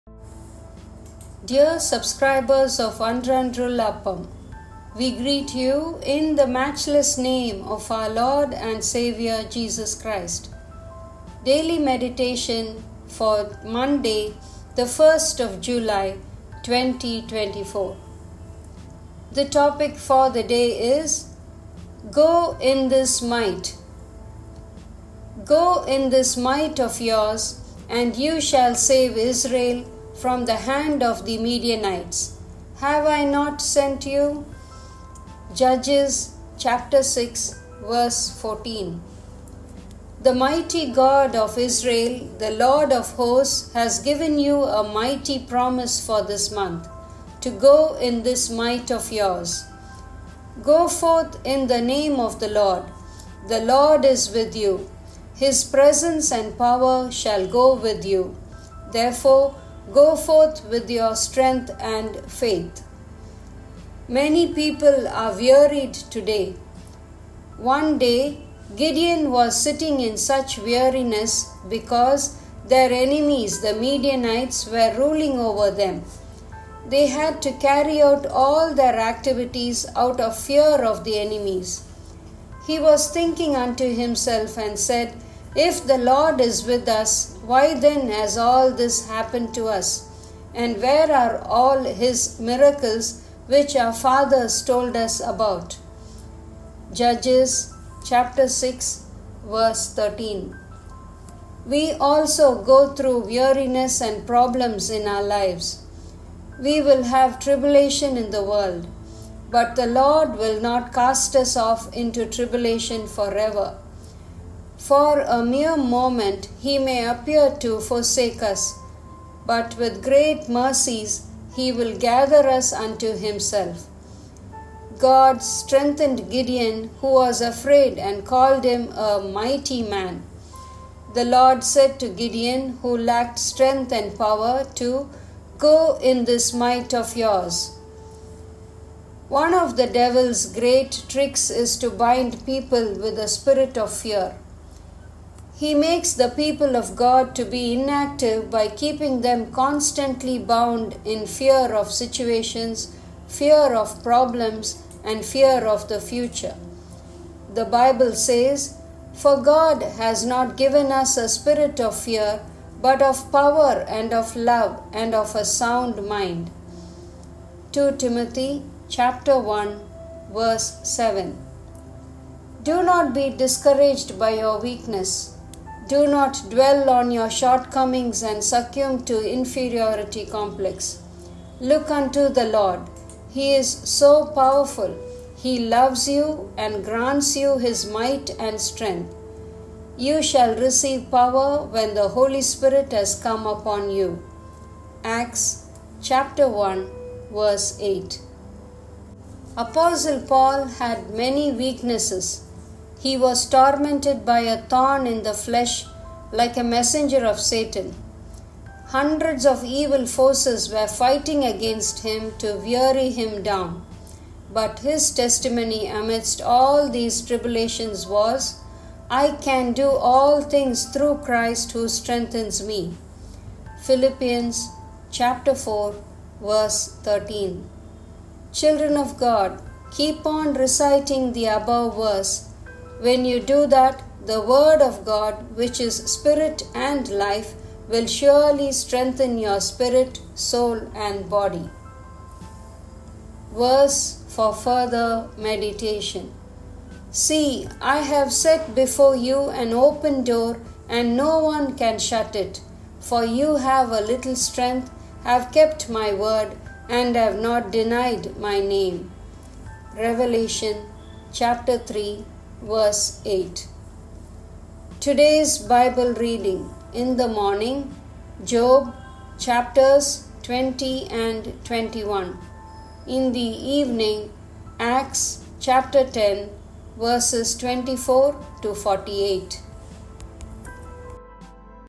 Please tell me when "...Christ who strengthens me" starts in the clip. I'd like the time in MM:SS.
03:41.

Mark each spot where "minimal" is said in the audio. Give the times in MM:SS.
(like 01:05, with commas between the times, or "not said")
not said.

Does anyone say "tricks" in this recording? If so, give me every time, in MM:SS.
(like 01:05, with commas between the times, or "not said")
02:21.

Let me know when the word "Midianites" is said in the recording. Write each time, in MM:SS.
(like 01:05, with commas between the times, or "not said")
00:31, 01:13.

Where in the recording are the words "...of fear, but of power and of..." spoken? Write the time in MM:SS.
02:41.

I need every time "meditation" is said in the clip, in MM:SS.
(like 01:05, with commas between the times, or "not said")
00:11, 04:05.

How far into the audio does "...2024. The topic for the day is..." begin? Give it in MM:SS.
00:16.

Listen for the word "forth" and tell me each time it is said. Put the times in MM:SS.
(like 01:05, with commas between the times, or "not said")
00:50, 01:00.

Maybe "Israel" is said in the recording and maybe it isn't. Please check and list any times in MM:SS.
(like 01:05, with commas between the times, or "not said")
00:29, 00:41.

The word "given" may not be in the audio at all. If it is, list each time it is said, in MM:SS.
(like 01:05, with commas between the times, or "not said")
00:43, 02:40.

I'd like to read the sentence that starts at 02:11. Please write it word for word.
The Lord said to Gideon, who lacked strength and power, to go in this might of yours.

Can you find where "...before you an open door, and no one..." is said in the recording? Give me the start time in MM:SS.
04:08.